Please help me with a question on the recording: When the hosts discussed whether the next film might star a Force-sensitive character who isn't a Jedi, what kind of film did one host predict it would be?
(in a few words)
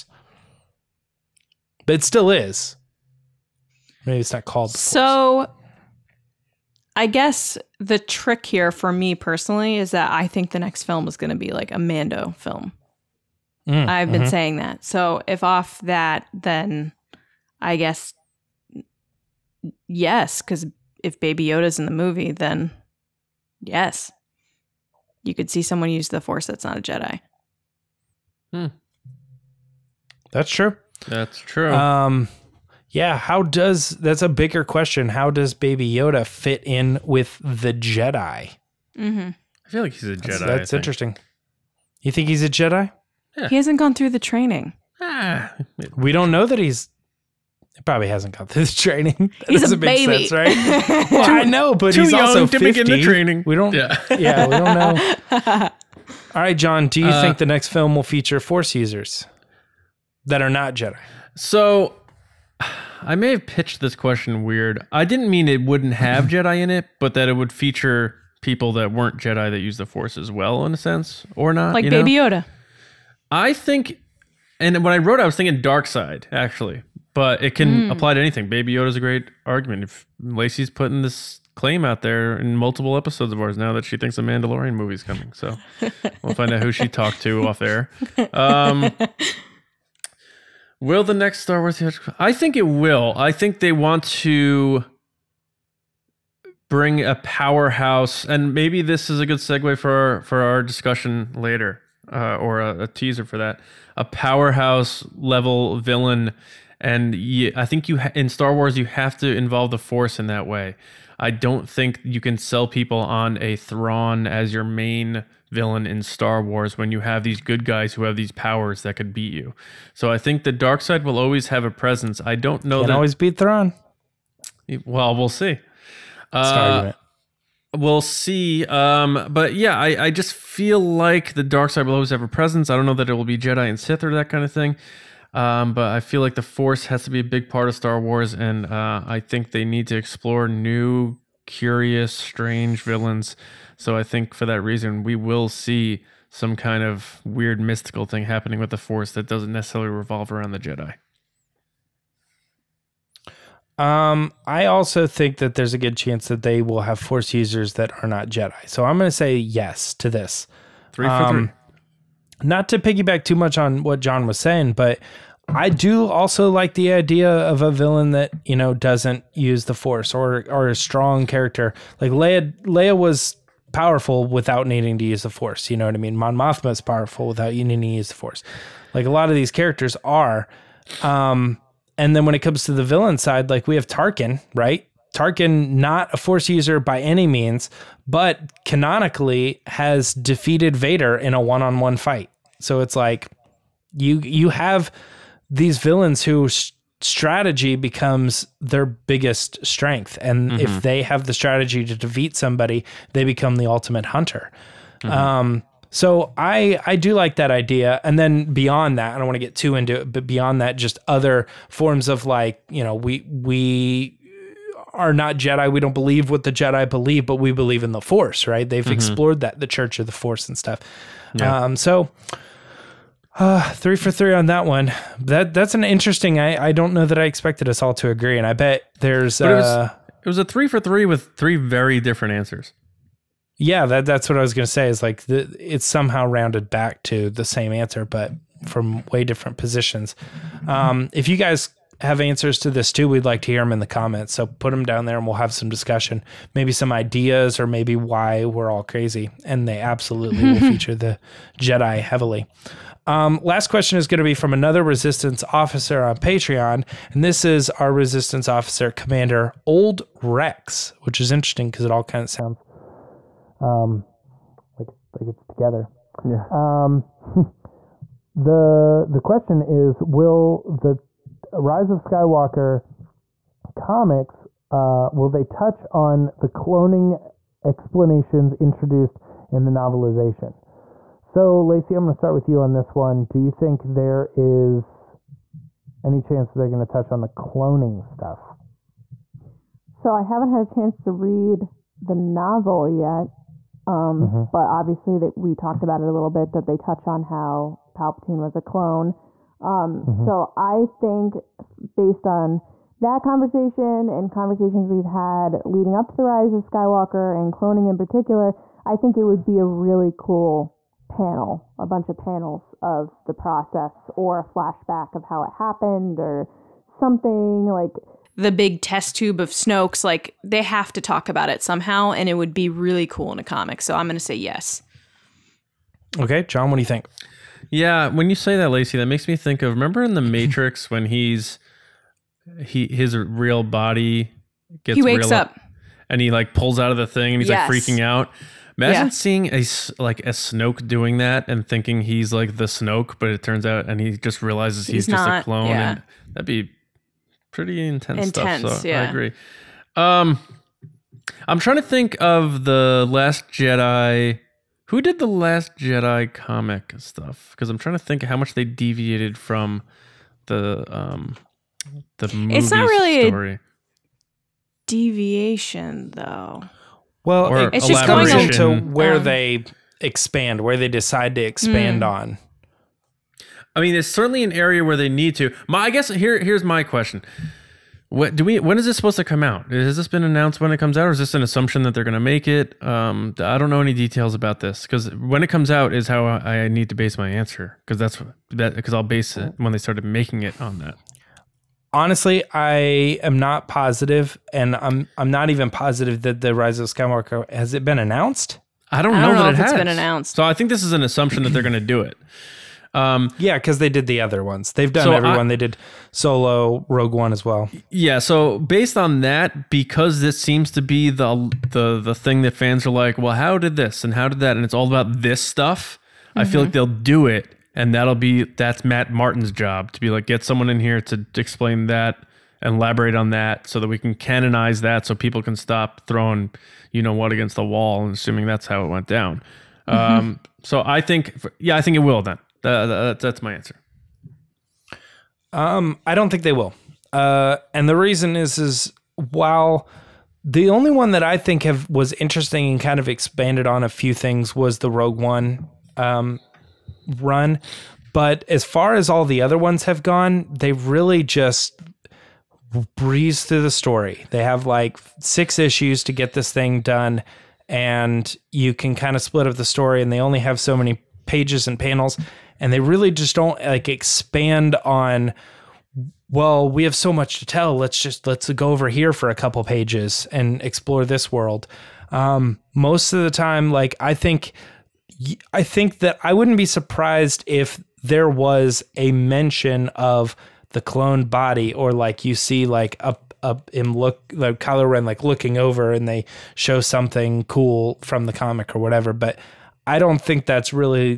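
Mando film.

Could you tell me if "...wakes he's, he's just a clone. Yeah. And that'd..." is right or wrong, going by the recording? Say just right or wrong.
wrong.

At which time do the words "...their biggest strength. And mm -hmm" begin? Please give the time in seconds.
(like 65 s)
198 s.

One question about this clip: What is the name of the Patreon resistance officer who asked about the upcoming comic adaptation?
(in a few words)
Commander Old Rex.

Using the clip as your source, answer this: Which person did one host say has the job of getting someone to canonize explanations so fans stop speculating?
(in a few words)
Matt Martin.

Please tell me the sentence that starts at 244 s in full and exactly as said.
So put them down there and we'll have some discussion, maybe some ideas or maybe why we're all crazy.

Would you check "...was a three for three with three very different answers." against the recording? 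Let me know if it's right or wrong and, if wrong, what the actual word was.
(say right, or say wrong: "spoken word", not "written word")
right.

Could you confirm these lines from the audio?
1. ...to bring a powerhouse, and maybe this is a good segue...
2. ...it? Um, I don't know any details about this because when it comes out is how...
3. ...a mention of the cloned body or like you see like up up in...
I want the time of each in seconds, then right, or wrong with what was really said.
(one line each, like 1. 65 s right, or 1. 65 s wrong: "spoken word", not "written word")
1. 94 s right
2. 382 s right
3. 478 s right.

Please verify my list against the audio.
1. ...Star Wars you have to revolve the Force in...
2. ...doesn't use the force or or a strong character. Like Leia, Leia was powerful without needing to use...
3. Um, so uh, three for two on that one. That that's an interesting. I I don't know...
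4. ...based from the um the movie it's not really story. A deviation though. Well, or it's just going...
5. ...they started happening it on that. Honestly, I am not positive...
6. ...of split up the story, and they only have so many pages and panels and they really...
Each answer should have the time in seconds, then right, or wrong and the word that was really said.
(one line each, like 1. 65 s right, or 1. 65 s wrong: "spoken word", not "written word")
1. 108 s wrong: "involve", not "revolve"
2. 168 s right
3. 221 s wrong: "three", not "two"
4. 358 s wrong: "deviated", not "based"
5. 389 s wrong: "making", not "happening"
6. 459 s right.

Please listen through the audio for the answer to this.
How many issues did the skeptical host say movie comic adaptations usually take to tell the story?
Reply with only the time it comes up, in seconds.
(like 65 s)
455 s.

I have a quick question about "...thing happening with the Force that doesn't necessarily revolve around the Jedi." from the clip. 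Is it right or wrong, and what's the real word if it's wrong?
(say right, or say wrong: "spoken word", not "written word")
right.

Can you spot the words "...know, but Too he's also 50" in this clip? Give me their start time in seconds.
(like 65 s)
51 s.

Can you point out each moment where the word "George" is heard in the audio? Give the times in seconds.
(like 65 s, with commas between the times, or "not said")
not said.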